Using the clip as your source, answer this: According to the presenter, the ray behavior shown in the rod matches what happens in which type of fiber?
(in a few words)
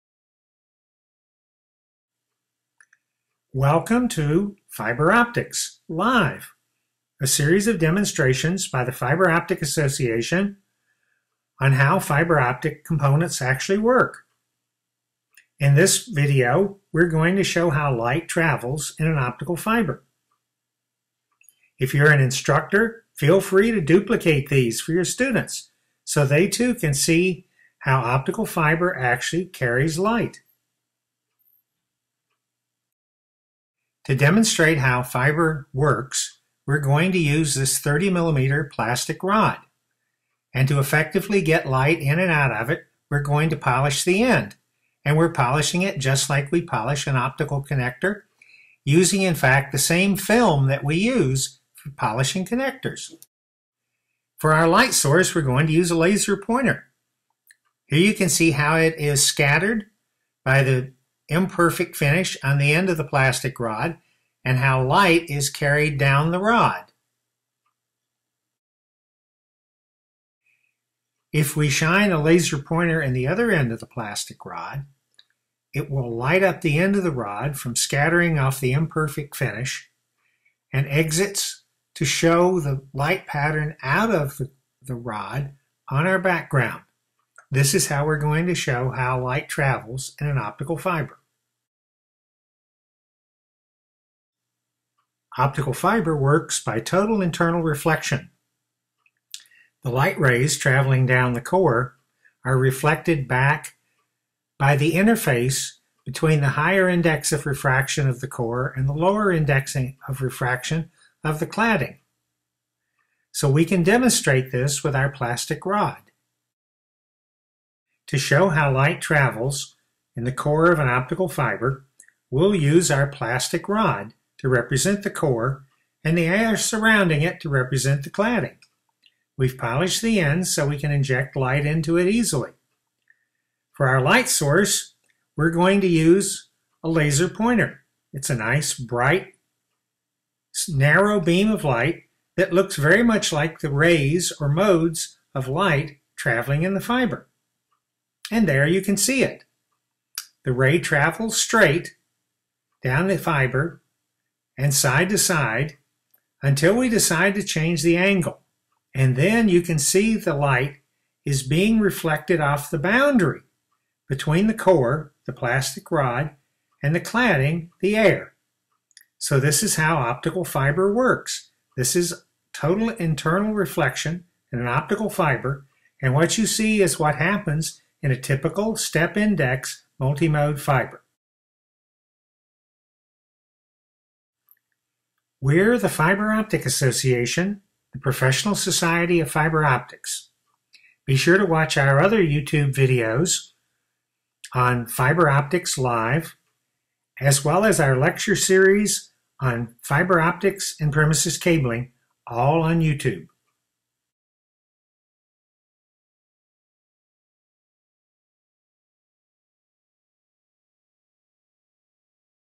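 step index multimode fiber.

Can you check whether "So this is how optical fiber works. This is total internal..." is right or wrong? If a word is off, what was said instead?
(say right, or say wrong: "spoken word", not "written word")
right.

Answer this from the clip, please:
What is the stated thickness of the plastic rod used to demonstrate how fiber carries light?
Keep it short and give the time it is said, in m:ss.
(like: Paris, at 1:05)
30 millimeters, at 0:37.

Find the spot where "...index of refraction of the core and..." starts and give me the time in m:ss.
1:46.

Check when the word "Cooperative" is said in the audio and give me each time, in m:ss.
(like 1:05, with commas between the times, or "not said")
not said.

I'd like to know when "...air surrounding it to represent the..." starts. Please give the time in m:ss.
2:06.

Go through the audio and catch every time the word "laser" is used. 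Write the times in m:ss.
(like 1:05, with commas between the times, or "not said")
0:55, 1:12, 2:16.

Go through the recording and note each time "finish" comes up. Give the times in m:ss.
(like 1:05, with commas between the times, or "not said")
1:01, 1:19.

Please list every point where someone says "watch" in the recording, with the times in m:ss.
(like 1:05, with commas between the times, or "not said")
3:11.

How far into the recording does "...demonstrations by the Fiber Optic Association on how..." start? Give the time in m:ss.
0:07.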